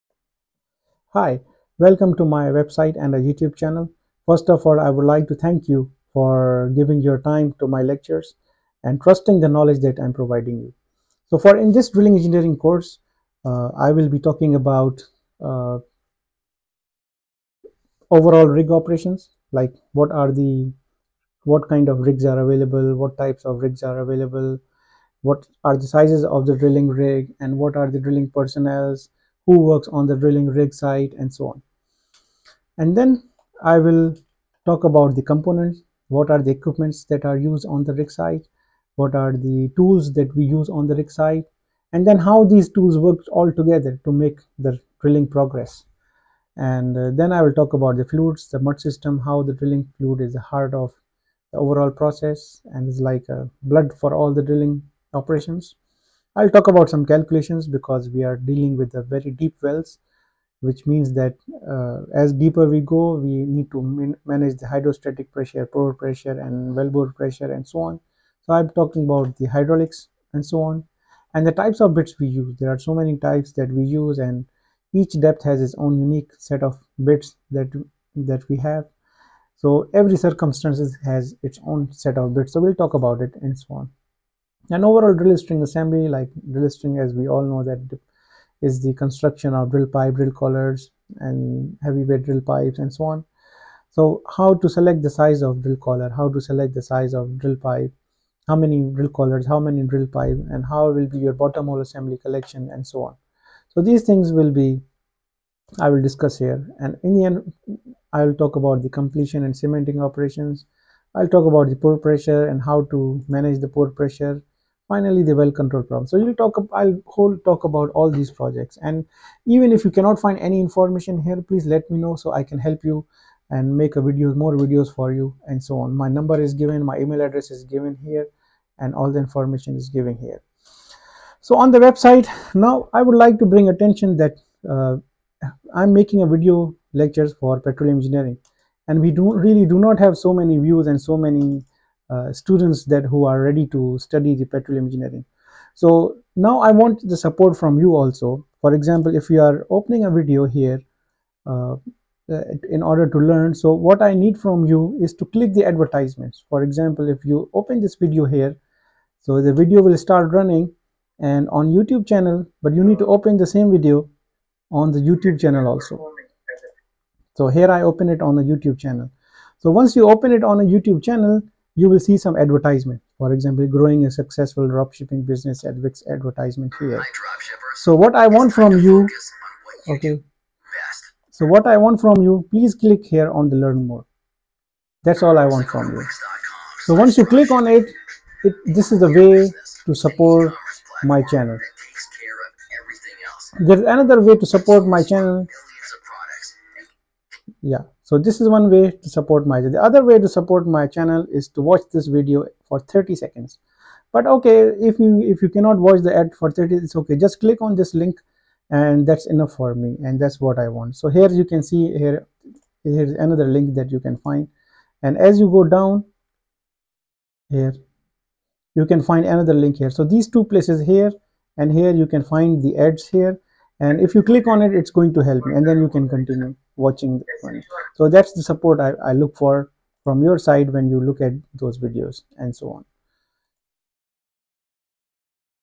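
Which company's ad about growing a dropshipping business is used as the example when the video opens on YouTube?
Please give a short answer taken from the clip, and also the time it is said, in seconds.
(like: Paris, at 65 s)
Wix, at 175 s.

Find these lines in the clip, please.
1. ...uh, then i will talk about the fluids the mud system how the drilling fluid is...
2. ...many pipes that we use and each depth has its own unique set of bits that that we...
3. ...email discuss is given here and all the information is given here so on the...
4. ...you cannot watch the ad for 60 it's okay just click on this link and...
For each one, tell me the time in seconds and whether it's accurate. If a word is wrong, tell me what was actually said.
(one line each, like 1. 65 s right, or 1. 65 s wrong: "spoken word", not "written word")
1. 46 s right
2. 72 s wrong: "types", not "pipes"
3. 127 s wrong: "address", not "discuss"
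4. 205 s wrong: "30", not "60".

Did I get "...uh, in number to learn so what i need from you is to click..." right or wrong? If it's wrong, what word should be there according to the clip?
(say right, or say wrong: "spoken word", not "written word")
wrong: "order", not "number".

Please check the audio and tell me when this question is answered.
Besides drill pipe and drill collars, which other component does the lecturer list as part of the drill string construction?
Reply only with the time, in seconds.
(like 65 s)
91 s.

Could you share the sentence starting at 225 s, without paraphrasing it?
and then you can continue watching one.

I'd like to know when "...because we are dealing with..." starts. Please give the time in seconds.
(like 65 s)
57 s.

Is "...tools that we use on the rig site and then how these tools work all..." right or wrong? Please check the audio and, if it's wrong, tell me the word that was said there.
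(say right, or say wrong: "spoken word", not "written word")
right.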